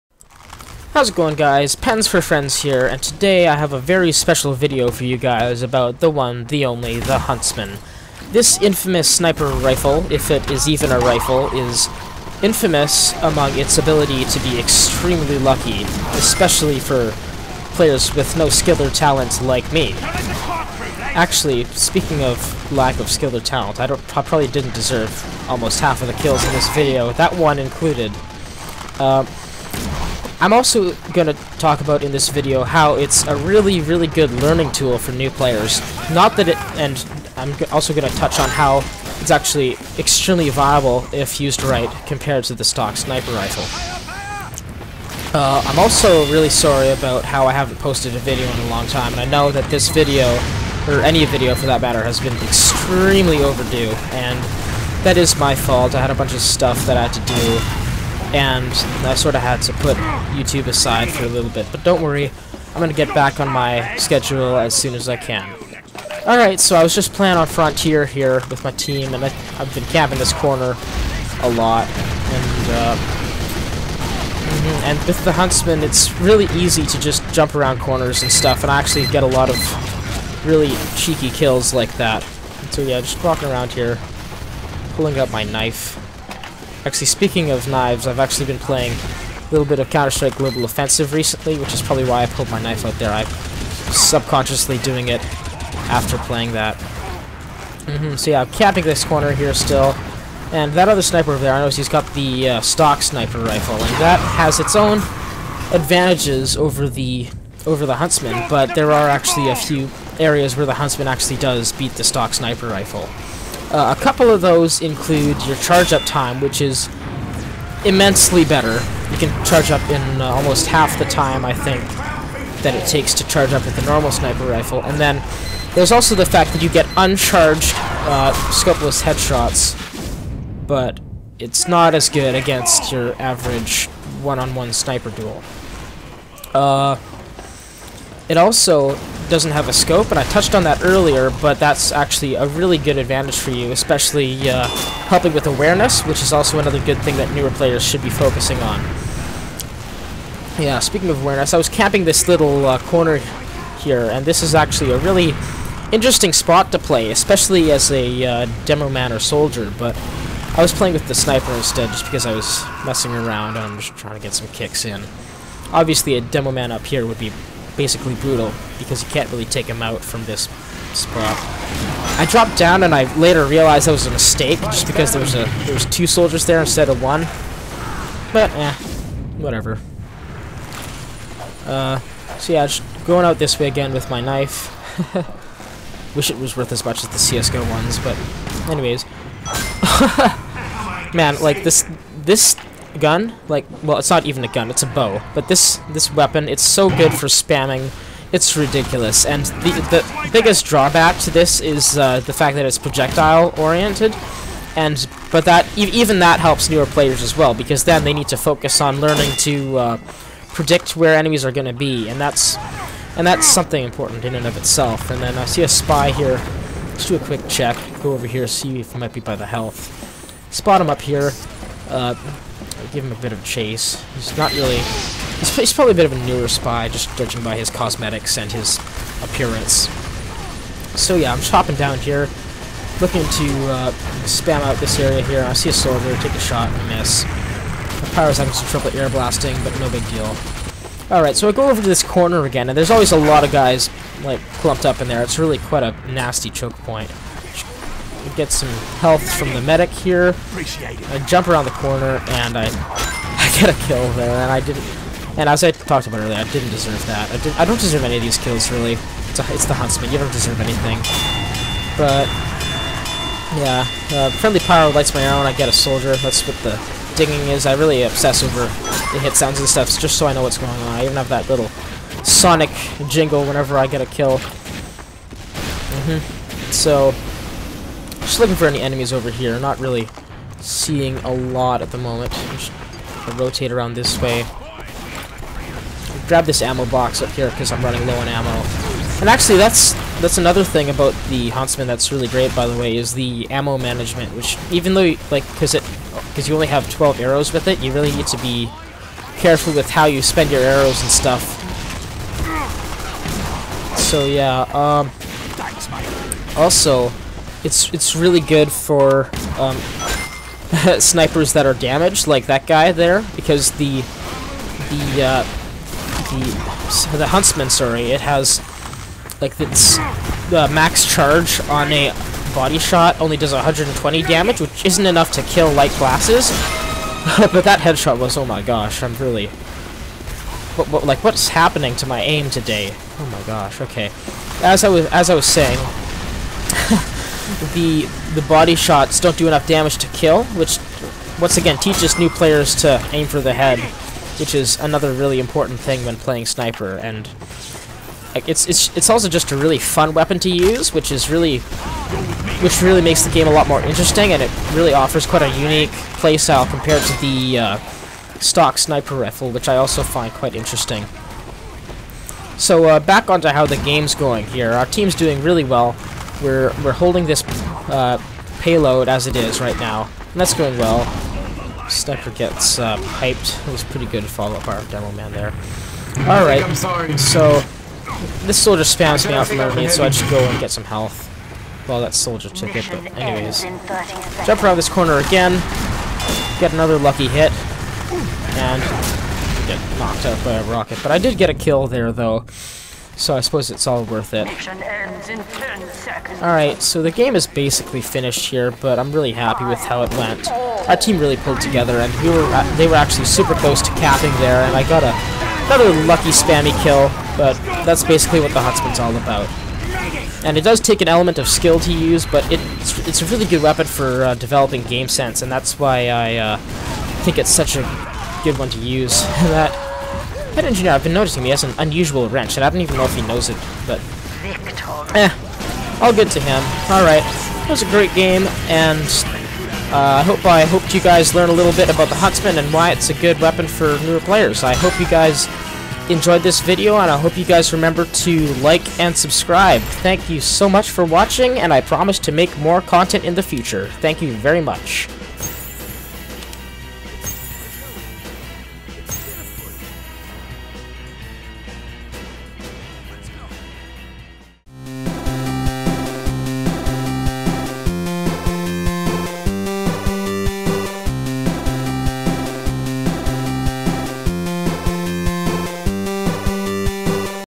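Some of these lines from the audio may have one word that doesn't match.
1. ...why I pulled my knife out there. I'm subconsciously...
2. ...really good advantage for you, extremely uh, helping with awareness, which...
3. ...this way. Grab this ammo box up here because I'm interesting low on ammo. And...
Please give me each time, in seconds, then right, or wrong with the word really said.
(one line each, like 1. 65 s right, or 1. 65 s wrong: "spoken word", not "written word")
1. 92 s right
2. 142 s wrong: "especially", not "extremely"
3. 283 s wrong: "running", not "interesting".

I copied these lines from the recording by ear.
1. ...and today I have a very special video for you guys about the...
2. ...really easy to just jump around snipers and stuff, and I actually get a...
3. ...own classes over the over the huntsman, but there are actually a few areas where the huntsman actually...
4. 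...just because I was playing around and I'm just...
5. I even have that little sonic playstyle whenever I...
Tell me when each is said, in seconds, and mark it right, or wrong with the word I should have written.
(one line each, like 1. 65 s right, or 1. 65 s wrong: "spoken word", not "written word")
1. 2 s right
2. 76 s wrong: "corners", not "snipers"
3. 104 s wrong: "advantages", not "classes"
4. 161 s wrong: "messing", not "playing"
5. 270 s wrong: "jingle", not "playstyle".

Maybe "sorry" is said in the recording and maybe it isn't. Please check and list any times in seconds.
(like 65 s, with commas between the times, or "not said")
46 s, 317 s.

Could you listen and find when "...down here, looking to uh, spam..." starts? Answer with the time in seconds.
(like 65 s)
231 s.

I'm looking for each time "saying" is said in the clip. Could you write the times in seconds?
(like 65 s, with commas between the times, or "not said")
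335 s.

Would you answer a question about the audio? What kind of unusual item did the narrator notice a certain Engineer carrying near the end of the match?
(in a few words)
Wrench.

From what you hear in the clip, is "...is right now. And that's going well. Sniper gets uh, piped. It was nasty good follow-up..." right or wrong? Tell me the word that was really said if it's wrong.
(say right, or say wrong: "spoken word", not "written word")
wrong: "pretty", not "nasty".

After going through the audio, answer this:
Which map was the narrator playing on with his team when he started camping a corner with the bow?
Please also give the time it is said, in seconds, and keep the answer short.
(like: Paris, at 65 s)
Frontier, at 67 s.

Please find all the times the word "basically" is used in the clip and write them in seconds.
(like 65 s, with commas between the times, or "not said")
167 s, 397 s, 408 s.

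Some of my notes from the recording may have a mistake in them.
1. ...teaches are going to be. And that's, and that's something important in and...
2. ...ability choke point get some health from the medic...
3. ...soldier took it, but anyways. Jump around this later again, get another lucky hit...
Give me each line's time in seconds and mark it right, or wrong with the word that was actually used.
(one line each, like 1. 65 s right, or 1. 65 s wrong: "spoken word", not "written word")
1. 211 s wrong: "enemies", not "teaches"
2. 246 s wrong: "nasty", not "ability"
3. 382 s wrong: "corner", not "later".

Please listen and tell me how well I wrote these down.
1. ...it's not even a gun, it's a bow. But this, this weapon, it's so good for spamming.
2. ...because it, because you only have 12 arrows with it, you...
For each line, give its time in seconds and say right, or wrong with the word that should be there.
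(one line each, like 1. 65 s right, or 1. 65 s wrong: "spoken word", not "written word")
1. 193 s right
2. 295 s right.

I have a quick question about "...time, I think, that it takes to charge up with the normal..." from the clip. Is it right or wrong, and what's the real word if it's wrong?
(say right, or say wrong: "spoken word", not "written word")
right.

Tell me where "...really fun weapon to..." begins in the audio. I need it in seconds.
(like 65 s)
349 s.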